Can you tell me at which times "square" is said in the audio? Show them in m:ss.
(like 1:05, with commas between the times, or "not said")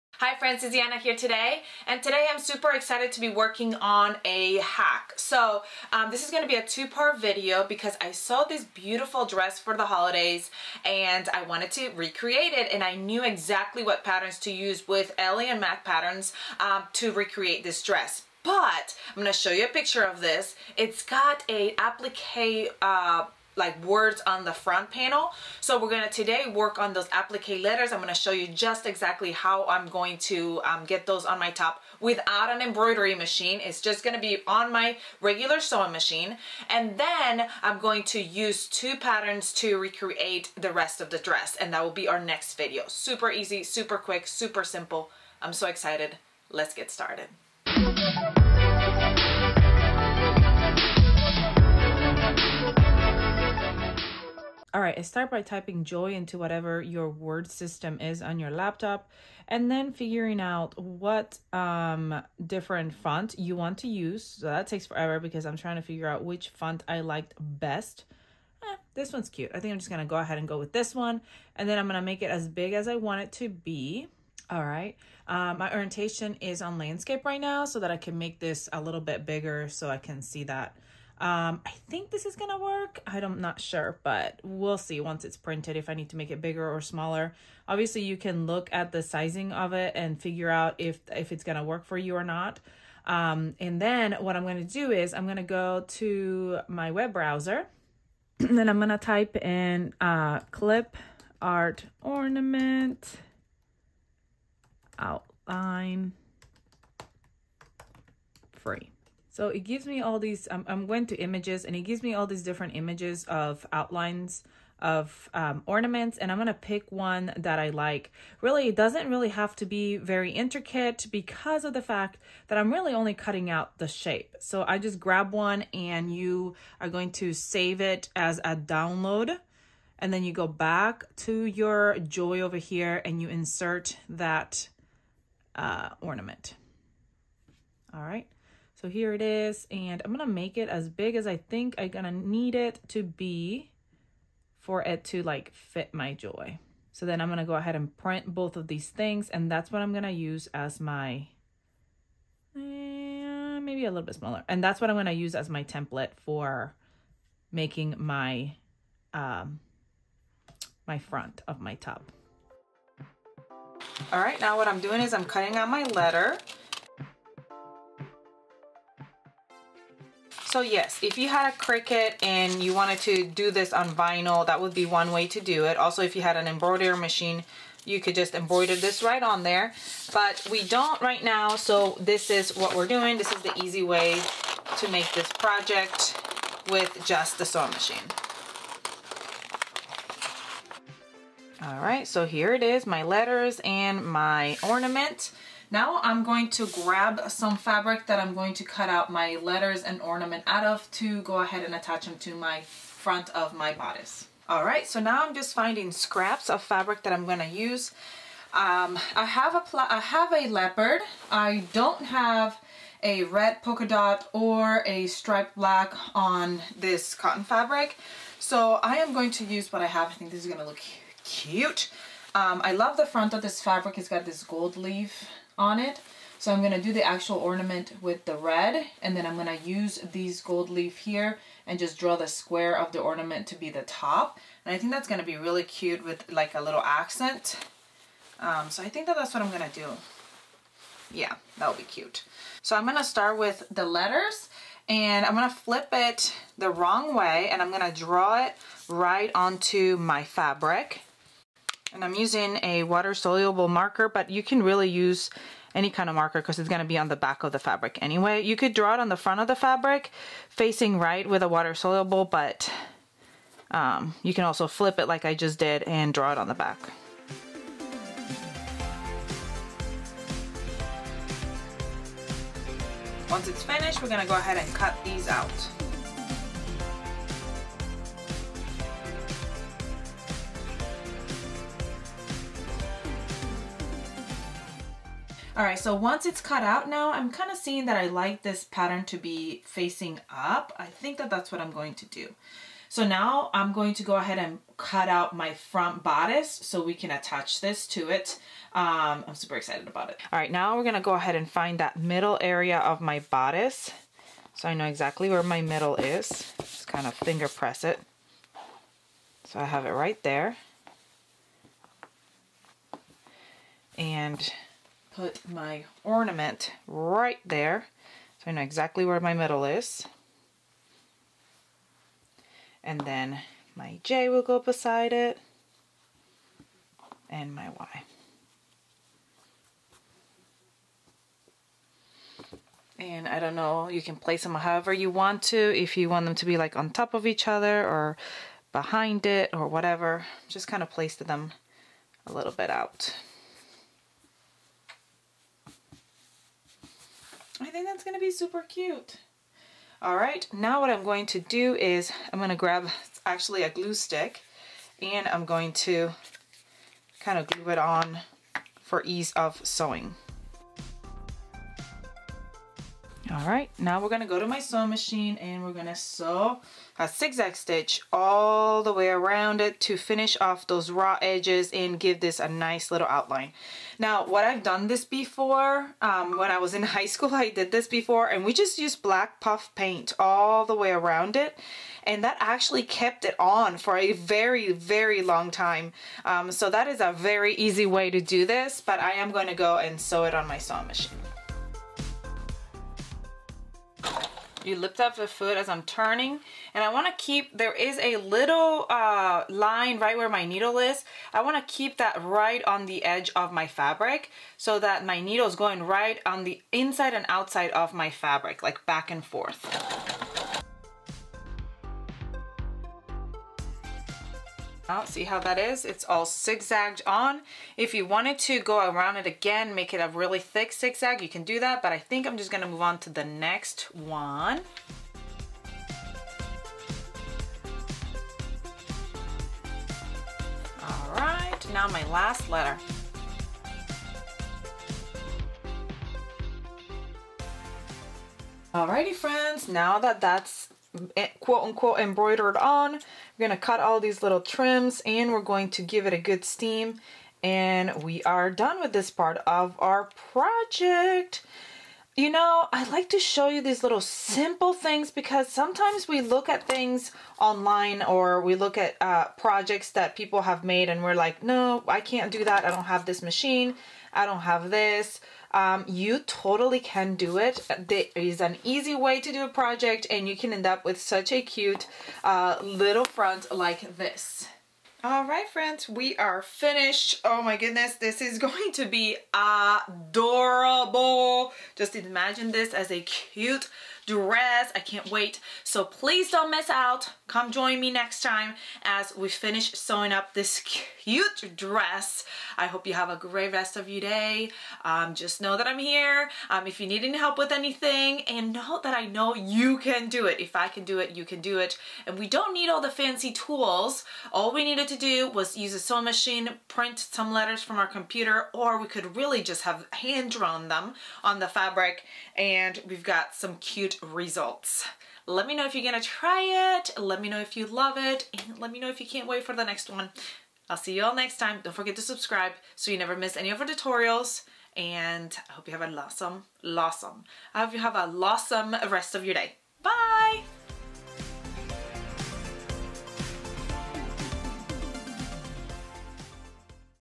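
3:52.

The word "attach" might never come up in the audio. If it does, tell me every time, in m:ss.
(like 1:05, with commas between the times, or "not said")
3:21, 4:57.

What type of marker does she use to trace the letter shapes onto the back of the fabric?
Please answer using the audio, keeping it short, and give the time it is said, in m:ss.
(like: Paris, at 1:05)
water-soluble marker, at 4:12.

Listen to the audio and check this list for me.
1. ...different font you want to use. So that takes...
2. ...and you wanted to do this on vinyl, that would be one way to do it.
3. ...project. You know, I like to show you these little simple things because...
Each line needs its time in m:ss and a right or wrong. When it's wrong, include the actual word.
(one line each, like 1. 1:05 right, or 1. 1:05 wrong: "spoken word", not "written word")
1. 1:02 right
2. 2:52 right
3. 7:30 right.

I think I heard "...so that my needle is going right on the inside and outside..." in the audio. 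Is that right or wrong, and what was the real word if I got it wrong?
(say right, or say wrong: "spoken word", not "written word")
right.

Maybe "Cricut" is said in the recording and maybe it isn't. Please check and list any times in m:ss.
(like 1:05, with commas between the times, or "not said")
2:51.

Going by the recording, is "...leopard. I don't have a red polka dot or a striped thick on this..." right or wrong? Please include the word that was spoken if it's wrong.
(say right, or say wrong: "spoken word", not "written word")
wrong: "black", not "thick".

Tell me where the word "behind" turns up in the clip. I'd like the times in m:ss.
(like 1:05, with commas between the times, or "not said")
5:38.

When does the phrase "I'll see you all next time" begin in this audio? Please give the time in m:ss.
8:40.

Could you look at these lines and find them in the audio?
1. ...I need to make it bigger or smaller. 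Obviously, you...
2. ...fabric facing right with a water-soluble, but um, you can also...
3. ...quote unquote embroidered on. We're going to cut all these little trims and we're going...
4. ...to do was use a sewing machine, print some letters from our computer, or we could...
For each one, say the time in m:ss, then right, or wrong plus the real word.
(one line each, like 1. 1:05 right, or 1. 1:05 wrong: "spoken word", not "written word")
1. 1:25 right
2. 4:19 right
3. 7:21 right
4. 8:24 right.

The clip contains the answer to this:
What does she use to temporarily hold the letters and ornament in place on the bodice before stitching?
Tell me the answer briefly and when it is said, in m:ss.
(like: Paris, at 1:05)
glue stick, at 5:53.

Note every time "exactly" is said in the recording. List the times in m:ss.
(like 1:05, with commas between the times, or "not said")
0:13, 0:28, 5:04, 5:18.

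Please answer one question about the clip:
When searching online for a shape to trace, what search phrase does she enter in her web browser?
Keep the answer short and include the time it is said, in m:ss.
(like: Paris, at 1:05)
clip art ornament outline free, at 1:40.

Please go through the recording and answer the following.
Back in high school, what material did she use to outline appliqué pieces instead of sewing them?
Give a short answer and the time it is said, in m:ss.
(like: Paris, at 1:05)
black puff paint, at 6:19.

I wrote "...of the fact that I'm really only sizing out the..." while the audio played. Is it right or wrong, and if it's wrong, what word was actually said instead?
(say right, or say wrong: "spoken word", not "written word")
wrong: "cutting", not "sizing".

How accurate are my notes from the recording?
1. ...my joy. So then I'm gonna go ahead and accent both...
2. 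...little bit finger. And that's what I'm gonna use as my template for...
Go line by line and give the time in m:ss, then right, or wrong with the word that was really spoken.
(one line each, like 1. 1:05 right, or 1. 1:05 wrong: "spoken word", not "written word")
1. 2:25 wrong: "print", not "accent"
2. 2:33 wrong: "smaller", not "finger".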